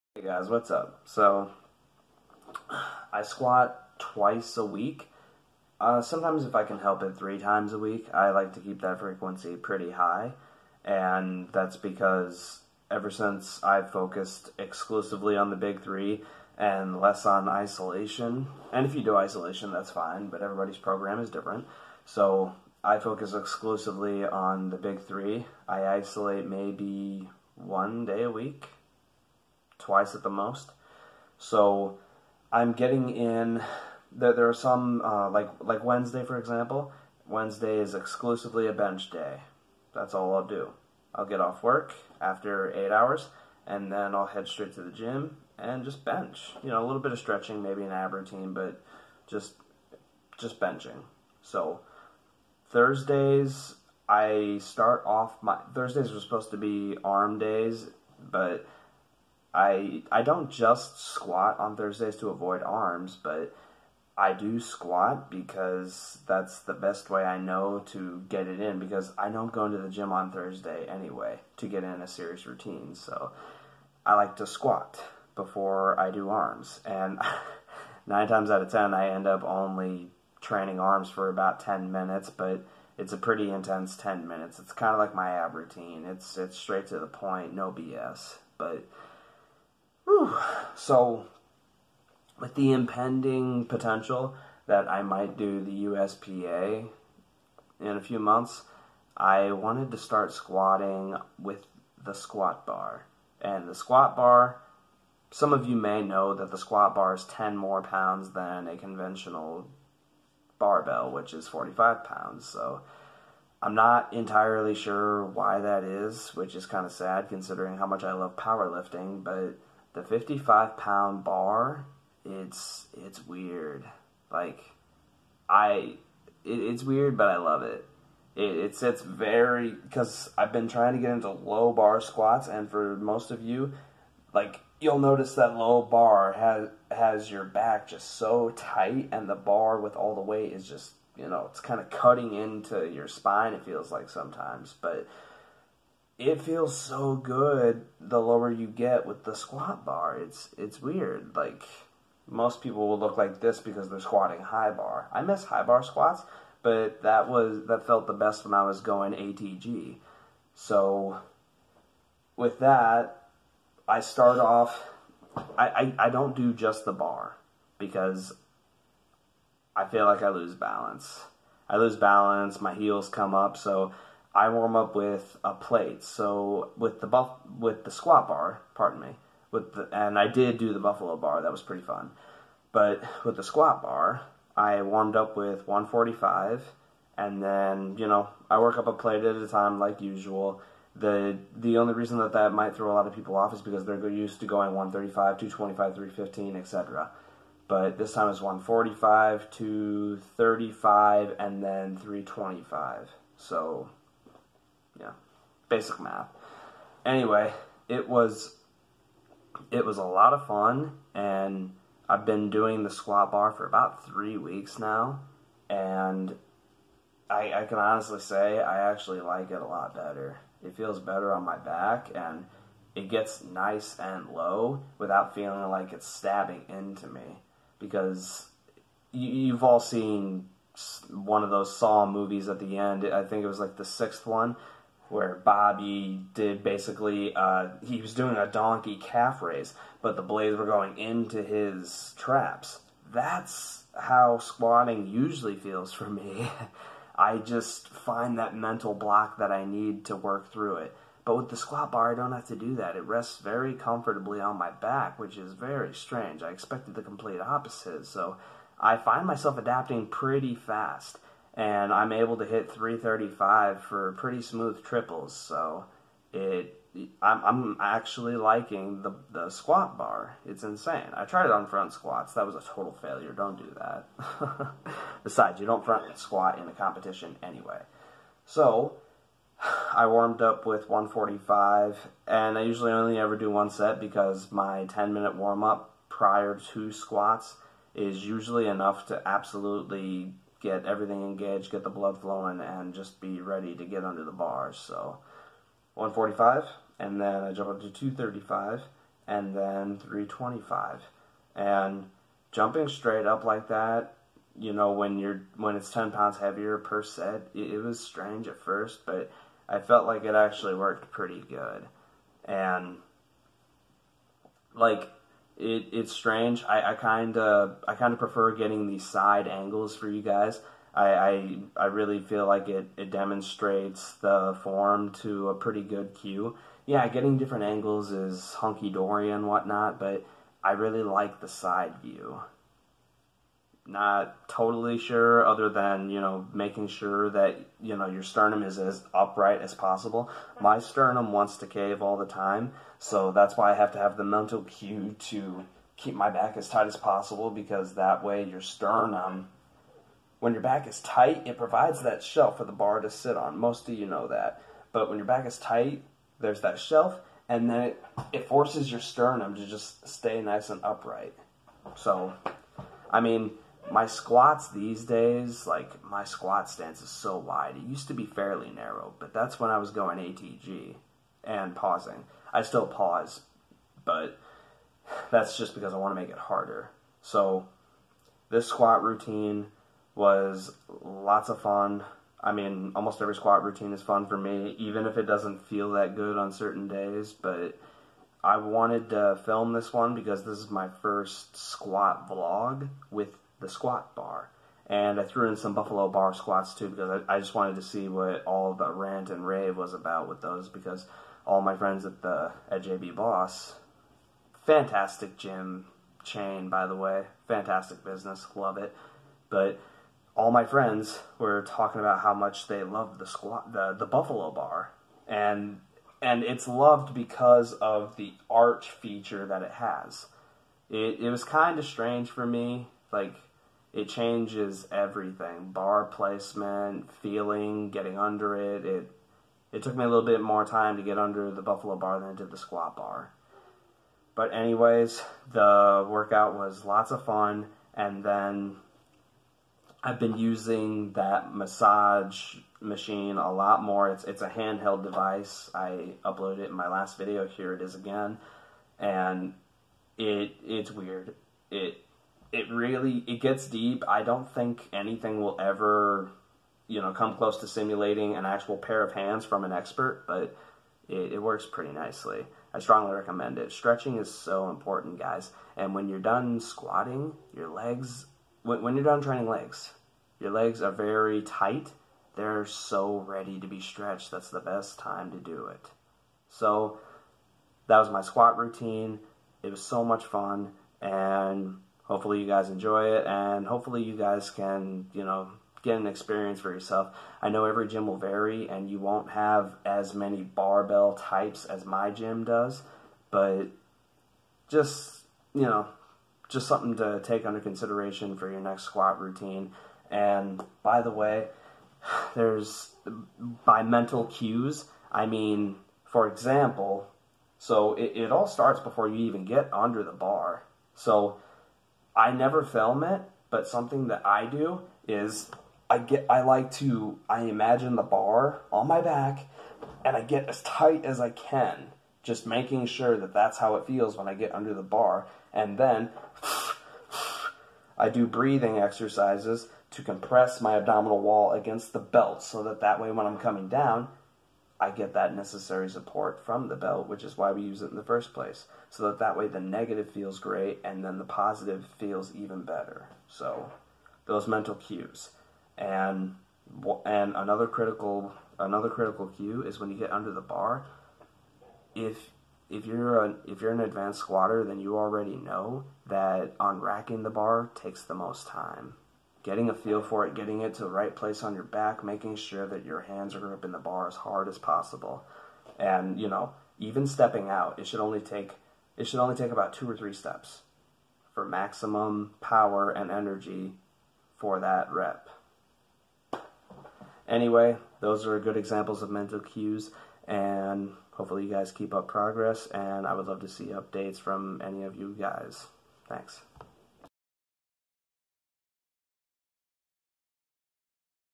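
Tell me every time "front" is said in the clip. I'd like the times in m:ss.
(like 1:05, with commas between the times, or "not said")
4:31, 4:35.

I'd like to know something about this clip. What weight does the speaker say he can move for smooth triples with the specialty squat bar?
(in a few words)
335.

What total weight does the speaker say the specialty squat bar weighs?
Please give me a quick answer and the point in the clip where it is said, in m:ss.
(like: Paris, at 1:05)
55 pounds, at 2:00.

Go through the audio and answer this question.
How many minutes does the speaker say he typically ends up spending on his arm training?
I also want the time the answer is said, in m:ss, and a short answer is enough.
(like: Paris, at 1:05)
10 minutes, at 1:21.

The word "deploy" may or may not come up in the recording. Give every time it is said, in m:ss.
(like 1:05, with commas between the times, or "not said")
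not said.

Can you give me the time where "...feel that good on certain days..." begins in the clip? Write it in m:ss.
6:25.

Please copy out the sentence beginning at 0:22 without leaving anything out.
So, I focus exclusively on the big three.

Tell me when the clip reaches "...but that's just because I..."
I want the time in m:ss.
6:14.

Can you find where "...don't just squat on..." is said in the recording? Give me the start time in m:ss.
1:00.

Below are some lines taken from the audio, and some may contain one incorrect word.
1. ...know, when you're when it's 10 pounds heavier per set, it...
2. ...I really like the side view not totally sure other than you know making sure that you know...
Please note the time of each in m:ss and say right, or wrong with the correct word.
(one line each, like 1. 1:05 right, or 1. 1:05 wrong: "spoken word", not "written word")
1. 5:04 right
2. 5:30 right.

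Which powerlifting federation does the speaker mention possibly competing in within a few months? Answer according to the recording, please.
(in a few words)
USPA.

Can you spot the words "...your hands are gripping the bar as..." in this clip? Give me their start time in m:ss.
9:22.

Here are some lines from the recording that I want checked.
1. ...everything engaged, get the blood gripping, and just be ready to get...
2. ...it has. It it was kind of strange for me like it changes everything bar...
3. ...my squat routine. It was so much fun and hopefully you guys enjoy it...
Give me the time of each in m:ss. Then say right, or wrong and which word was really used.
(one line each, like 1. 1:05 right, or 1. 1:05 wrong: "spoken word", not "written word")
1. 4:50 wrong: "flowing", not "gripping"
2. 6:59 right
3. 7:58 right.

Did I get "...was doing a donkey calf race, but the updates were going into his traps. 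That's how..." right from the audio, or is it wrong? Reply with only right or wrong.
wrong.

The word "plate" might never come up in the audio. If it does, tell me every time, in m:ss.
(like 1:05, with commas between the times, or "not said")
2:55, 3:08.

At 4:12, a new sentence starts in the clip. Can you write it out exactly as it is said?
It rests very comfortably on my back, which is very strange.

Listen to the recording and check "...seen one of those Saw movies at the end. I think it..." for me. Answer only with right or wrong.
right.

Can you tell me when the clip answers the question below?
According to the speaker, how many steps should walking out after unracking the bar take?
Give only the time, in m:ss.
9:29.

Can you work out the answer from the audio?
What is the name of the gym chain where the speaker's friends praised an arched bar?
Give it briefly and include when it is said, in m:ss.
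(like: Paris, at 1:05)
JB Boss, at 6:42.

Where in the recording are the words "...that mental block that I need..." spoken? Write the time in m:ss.
4:08.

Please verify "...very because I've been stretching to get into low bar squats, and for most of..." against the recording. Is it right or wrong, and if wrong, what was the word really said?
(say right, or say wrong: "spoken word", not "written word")
wrong: "trying", not "stretching".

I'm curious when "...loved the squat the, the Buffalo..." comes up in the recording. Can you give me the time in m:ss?
6:52.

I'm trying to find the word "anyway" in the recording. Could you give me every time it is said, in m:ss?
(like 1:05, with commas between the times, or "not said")
1:10, 3:27, 4:37, 7:14, 9:37.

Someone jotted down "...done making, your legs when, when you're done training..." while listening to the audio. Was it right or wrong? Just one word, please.
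wrong.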